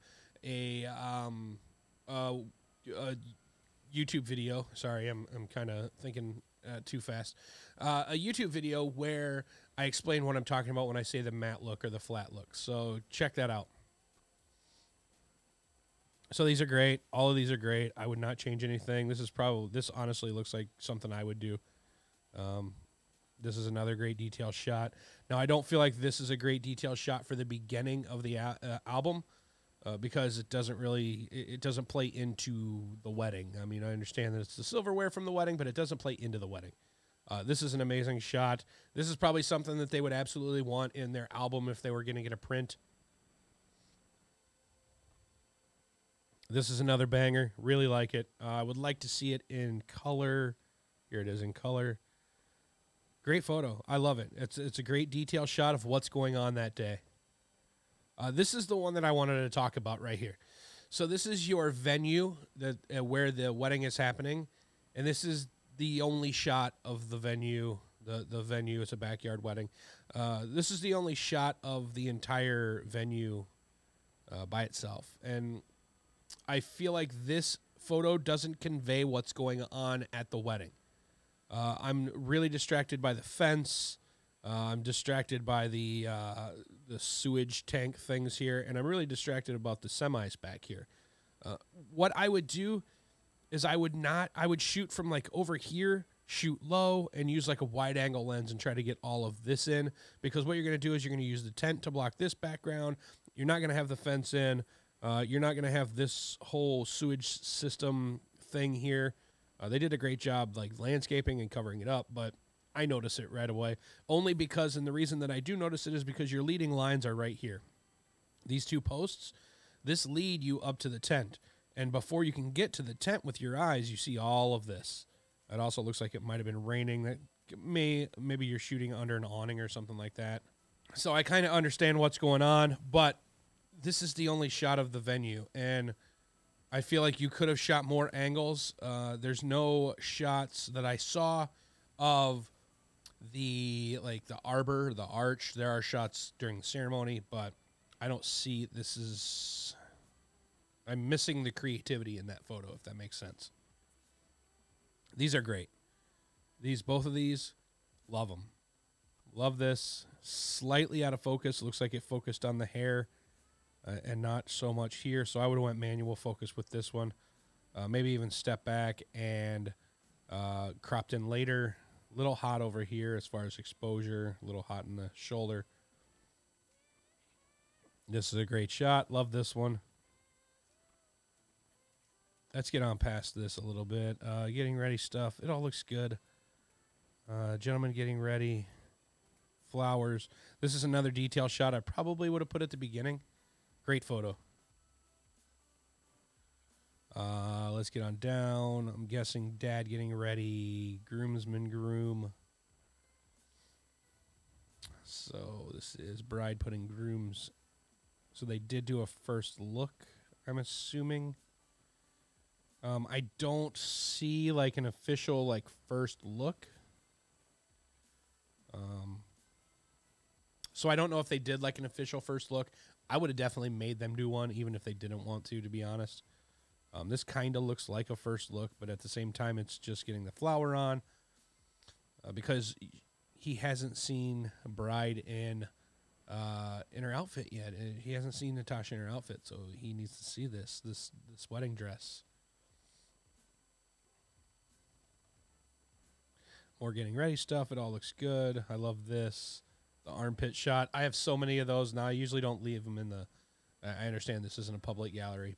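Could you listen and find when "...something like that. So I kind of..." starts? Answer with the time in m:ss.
2:09.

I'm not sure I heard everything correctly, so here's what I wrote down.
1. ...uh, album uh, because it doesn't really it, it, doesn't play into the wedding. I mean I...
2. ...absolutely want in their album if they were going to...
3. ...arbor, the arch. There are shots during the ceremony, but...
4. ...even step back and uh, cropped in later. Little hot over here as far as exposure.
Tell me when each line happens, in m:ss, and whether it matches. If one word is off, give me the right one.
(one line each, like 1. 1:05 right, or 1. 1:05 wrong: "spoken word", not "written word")
1. 0:28 right
2. 0:40 right
3. 2:24 right
4. 2:48 right.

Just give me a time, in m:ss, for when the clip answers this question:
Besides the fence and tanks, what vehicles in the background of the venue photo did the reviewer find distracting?
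1:29.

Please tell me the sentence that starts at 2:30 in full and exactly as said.
I'm missing the creativity in that photo, if that makes sense.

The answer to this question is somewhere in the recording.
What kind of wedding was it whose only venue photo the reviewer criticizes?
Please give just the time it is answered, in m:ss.
1:08.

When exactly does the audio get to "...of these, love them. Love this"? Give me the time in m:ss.
2:37.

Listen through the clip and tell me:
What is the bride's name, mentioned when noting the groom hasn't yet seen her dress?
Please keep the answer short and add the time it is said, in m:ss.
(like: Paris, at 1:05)
Natasha, at 3:58.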